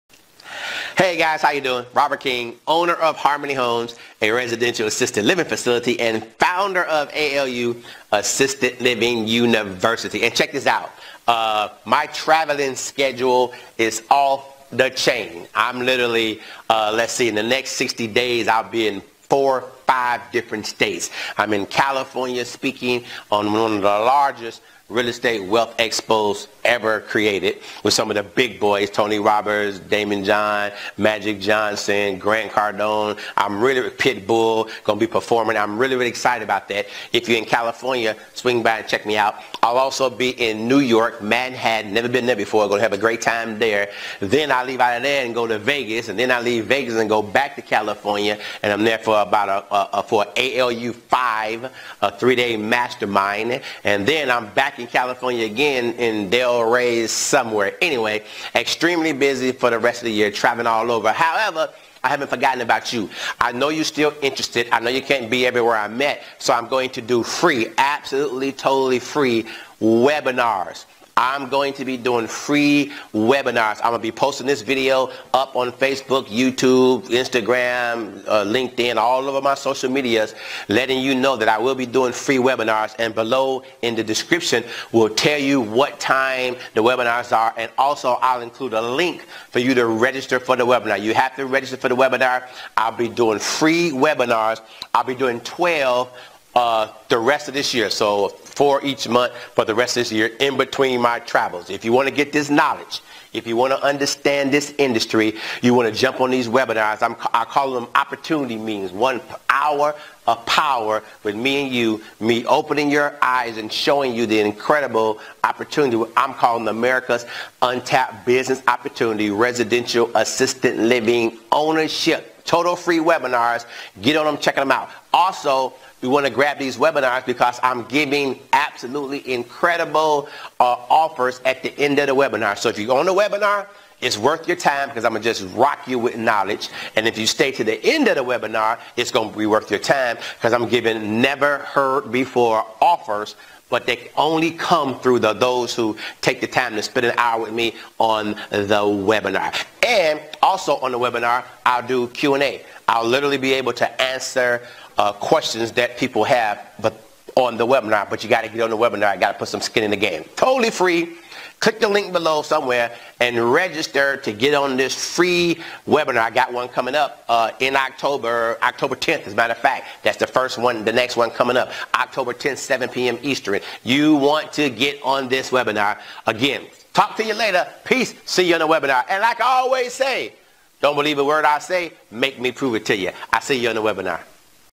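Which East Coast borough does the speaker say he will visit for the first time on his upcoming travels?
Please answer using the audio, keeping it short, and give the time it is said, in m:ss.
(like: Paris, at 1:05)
Manhattan, at 0:41.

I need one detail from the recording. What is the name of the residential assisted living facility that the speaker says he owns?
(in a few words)
Harmony Homes.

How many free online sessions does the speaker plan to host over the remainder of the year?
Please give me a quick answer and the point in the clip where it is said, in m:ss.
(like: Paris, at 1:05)
12, at 1:35.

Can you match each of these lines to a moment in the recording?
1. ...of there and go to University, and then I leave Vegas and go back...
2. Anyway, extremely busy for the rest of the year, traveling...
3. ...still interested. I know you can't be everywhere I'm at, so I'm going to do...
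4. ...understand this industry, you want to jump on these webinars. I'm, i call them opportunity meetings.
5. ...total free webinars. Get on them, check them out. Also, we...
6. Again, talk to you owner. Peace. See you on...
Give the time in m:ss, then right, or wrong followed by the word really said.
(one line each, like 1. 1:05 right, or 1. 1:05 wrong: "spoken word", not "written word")
1. 0:44 wrong: "Vegas", not "University"
2. 0:57 right
3. 1:03 right
4. 1:43 right
5. 2:02 right
6. 2:56 wrong: "later", not "owner".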